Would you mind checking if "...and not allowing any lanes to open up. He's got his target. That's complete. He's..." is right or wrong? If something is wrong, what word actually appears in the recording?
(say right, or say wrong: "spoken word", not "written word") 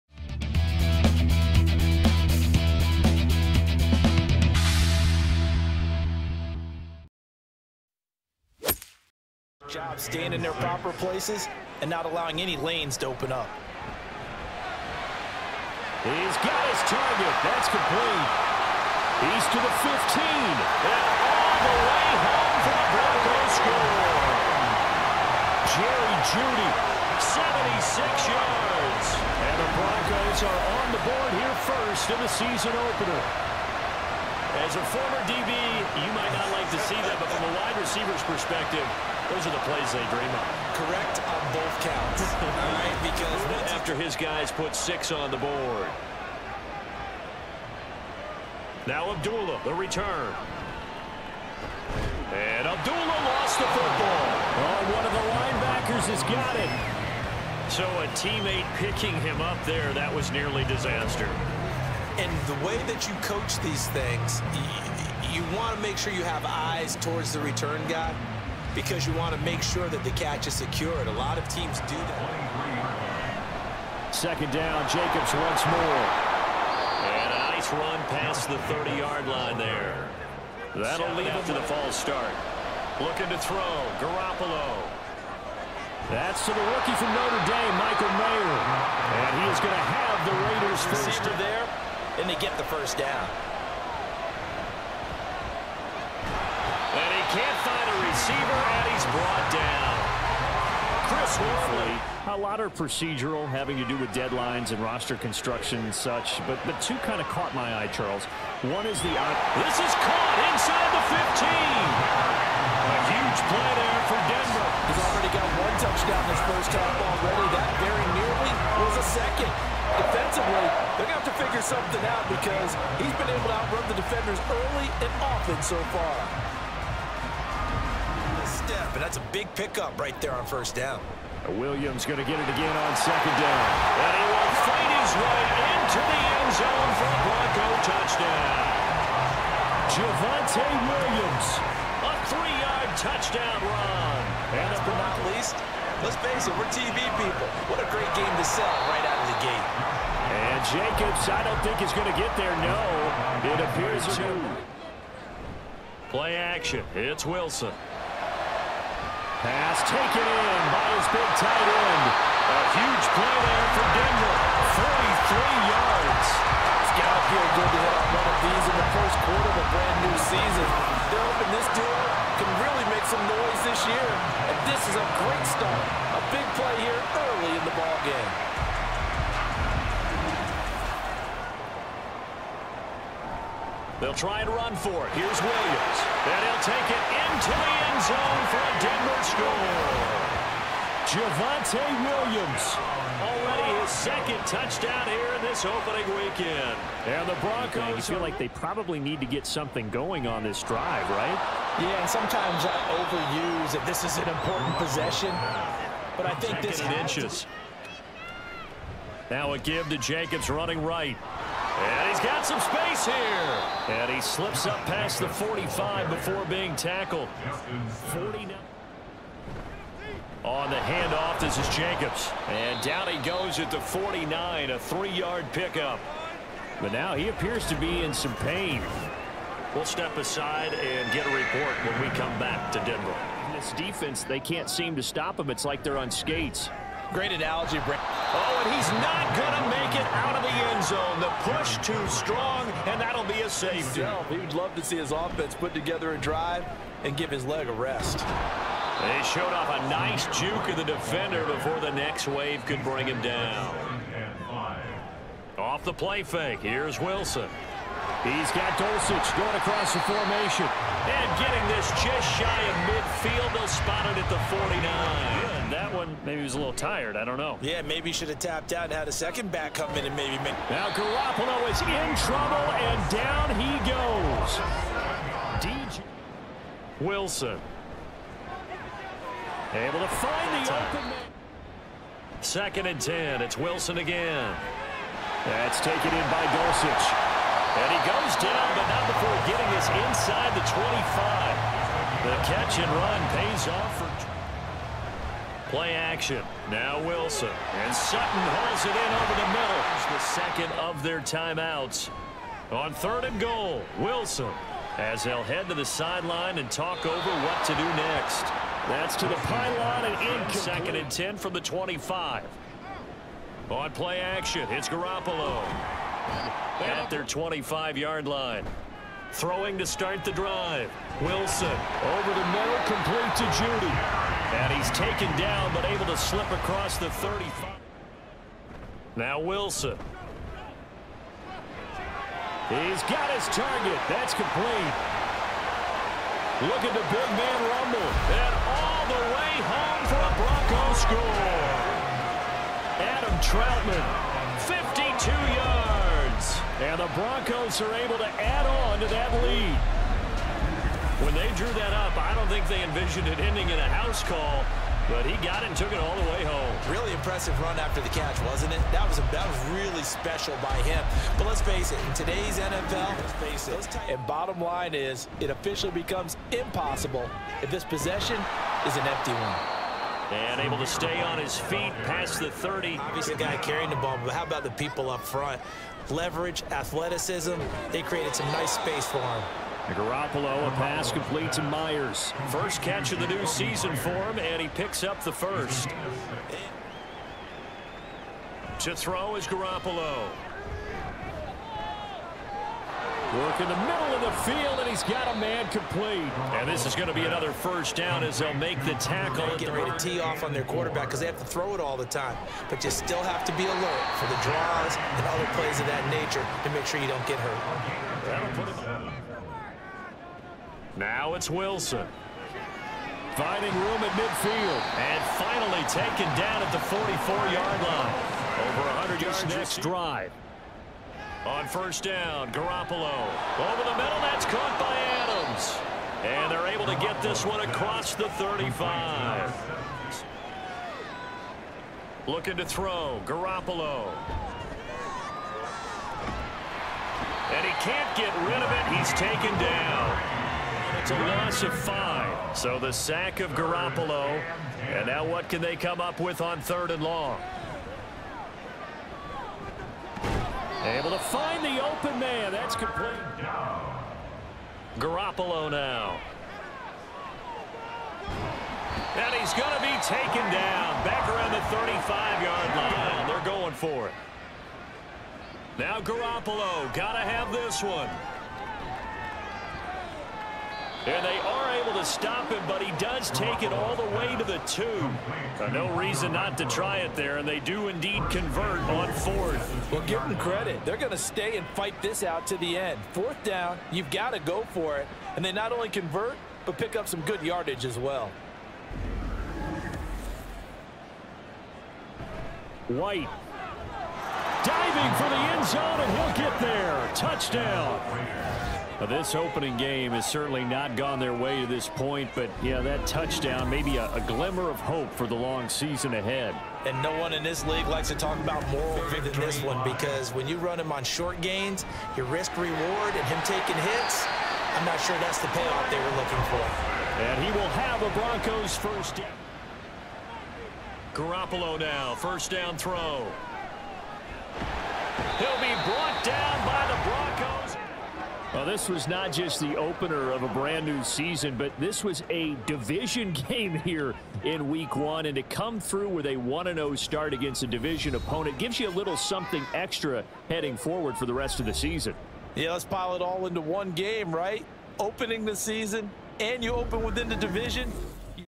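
right.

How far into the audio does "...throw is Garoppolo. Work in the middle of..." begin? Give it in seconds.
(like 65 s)
388 s.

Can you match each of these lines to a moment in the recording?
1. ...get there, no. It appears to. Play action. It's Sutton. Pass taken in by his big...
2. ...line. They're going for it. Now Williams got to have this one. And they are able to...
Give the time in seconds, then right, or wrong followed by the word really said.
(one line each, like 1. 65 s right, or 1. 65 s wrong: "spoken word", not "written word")
1. 152 s wrong: "Wilson", not "Sutton"
2. 462 s wrong: "Garoppolo", not "Williams".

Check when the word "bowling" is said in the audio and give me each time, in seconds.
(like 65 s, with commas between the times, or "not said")
not said.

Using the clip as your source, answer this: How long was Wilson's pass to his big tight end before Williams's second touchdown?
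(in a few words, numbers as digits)
43 yards.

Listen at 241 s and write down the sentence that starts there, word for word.
The push too strong, and that'll be a safety.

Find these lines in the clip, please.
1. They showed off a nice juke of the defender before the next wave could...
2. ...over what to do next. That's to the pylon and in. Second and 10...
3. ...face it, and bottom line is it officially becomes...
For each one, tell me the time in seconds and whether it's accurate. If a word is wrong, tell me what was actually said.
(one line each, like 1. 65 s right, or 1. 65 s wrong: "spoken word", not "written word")
1. 248 s right
2. 307 s right
3. 363 s right.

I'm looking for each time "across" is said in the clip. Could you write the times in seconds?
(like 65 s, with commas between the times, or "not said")
259 s, 326 s, 427 s.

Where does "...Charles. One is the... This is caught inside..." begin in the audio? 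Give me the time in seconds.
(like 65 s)
107 s.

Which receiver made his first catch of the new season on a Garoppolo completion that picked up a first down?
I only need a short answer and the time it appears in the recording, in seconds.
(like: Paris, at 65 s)
Meyers, at 381 s.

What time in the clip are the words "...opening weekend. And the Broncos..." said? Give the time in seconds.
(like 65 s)
195 s.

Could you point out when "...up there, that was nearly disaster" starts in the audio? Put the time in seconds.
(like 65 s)
59 s.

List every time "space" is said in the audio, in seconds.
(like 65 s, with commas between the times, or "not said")
212 s, 378 s.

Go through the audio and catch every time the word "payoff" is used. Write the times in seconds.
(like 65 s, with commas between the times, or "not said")
515 s.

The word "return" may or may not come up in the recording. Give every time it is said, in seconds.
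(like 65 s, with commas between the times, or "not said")
49 s, 67 s.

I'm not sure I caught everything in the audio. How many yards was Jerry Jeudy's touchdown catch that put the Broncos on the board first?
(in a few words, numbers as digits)
76.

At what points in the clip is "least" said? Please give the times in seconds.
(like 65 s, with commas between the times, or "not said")
145 s.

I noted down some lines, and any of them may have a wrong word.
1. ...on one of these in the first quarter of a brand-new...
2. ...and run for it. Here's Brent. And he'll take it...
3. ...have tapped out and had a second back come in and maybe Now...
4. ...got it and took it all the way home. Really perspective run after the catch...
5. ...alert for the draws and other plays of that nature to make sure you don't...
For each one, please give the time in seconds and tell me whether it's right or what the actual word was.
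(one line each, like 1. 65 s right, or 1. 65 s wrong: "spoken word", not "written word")
1. 167 s right
2. 184 s wrong: "Williams", not "Brent"
3. 268 s right
4. 355 s wrong: "impressive", not "perspective"
5. 403 s right.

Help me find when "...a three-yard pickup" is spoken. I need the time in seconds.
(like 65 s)
224 s.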